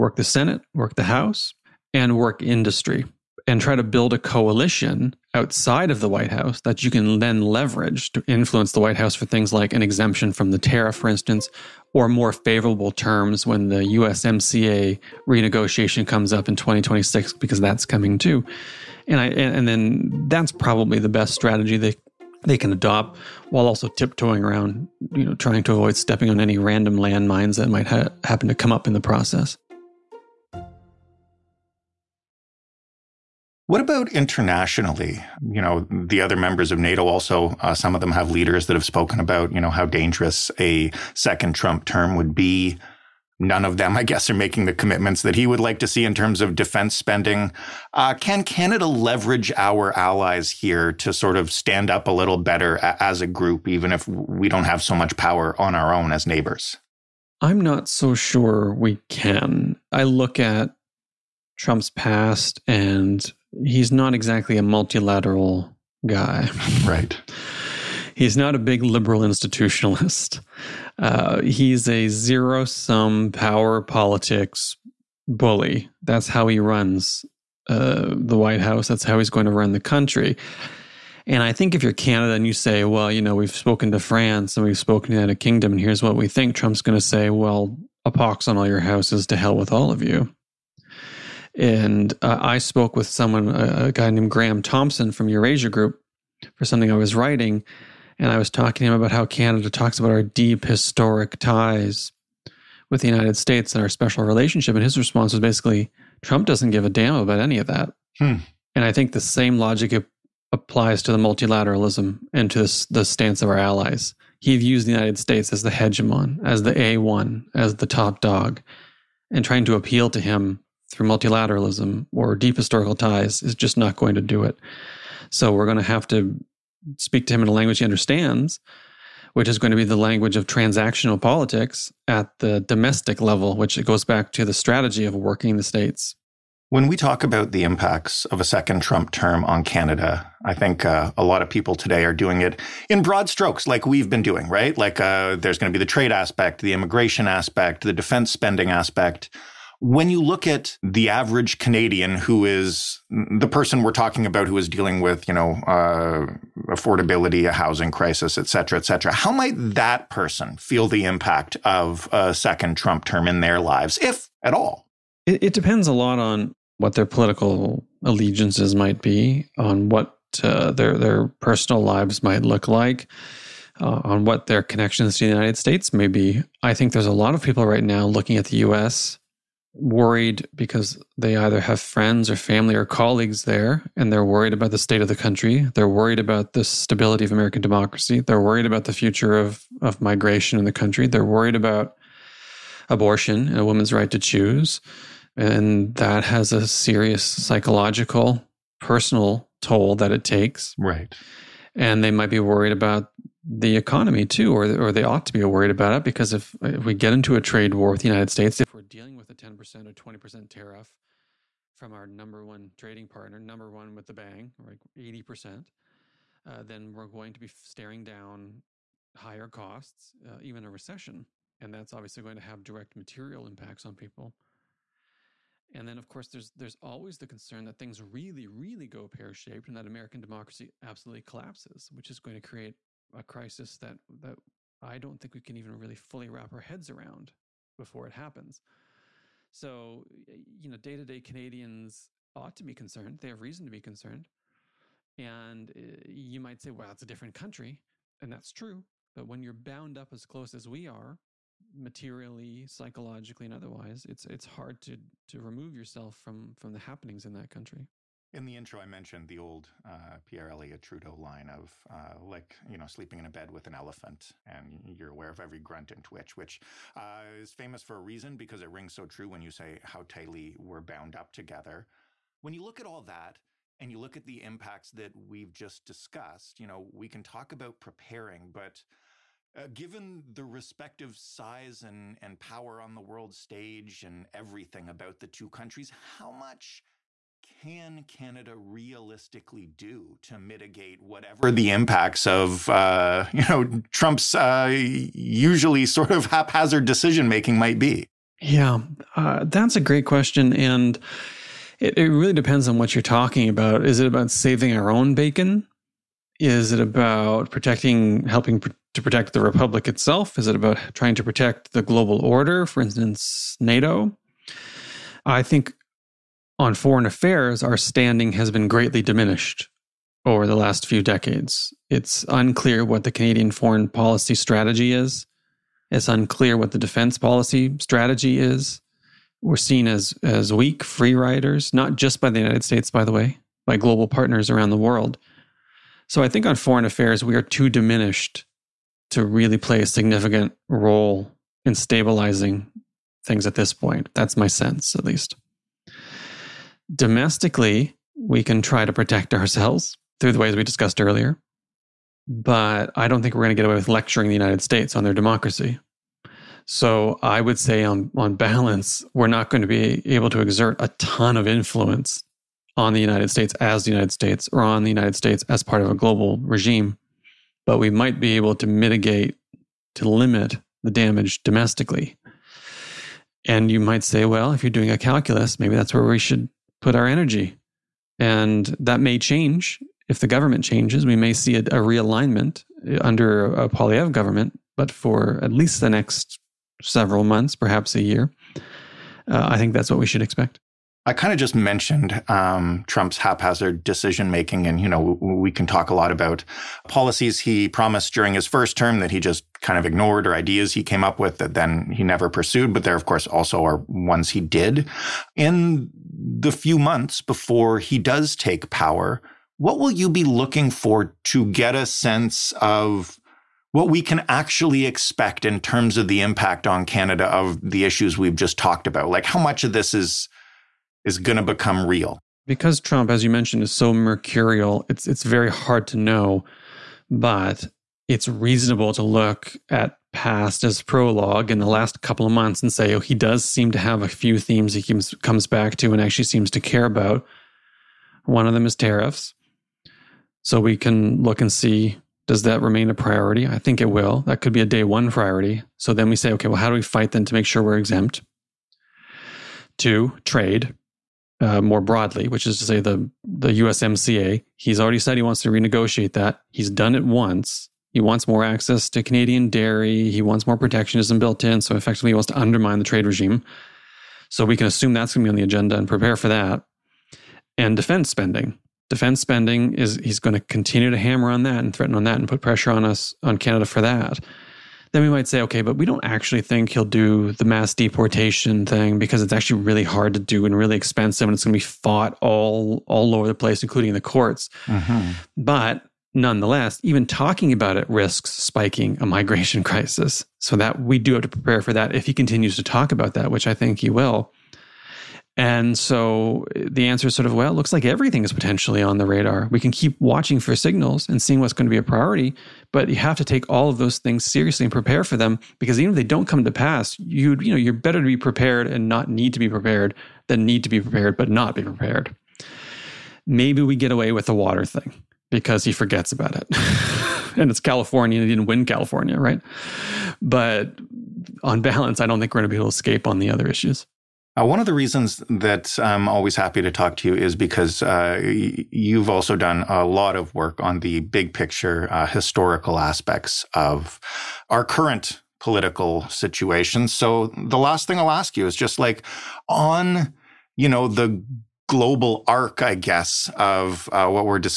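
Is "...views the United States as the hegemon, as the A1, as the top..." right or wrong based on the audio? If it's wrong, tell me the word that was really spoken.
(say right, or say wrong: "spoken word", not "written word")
right.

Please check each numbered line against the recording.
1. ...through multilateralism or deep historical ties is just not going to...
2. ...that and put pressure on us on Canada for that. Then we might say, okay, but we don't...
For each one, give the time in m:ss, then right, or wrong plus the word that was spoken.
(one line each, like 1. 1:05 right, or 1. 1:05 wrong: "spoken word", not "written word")
1. 2:00 right
2. 7:52 right.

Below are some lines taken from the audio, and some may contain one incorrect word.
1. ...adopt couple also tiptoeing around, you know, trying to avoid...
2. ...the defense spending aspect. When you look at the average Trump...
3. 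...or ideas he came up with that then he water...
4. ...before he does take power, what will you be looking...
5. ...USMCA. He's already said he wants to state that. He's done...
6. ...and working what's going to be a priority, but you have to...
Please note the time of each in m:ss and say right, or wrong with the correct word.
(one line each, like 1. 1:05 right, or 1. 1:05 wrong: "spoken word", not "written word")
1. 0:22 wrong: "while", not "couple"
2. 2:27 wrong: "Canadian", not "Trump"
3. 6:40 wrong: "never", not "water"
4. 6:47 right
5. 7:33 wrong: "renegotiate", not "state"
6. 8:21 wrong: "seeing", not "working".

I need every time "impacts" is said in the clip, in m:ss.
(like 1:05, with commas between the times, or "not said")
2:17, 2:41, 3:43, 4:34, 4:51, 6:56.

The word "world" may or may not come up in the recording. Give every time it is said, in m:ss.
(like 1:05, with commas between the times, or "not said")
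4:43, 5:34.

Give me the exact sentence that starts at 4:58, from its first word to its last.
Yeah, uh, that's a great question, and it, it really depends on what you're talking about.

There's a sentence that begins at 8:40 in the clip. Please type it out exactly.
But on balance, I don't think we're going to be able to escape on the other issues.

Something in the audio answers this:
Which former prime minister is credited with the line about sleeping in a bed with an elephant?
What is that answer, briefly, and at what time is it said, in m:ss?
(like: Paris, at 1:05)
Pierre Elliott Trudeau, at 4:20.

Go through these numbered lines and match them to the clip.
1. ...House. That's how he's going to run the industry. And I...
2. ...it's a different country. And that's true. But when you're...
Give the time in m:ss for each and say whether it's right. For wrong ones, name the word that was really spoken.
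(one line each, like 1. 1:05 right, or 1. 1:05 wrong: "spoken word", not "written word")
1. 1:18 wrong: "country", not "industry"
2. 4:06 right.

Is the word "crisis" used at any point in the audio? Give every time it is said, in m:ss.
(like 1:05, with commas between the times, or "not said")
2:37, 3:53, 8:09.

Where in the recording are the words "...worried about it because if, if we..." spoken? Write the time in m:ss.
3:25.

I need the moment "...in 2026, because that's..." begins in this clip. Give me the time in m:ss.
0:16.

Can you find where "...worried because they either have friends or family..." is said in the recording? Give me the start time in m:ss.
2:59.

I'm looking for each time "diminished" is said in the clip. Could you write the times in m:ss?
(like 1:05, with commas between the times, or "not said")
5:19, 5:37.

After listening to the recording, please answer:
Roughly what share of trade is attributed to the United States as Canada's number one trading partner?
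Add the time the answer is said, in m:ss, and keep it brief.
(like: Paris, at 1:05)
80 percent, at 3:34.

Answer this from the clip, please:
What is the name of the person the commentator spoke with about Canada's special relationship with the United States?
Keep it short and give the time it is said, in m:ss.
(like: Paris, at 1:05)
Graeme Thomson, at 1:34.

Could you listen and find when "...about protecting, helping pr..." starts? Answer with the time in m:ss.
5:06.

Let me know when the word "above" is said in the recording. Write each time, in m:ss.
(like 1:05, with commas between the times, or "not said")
not said.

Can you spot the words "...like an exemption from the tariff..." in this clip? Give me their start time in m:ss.
0:09.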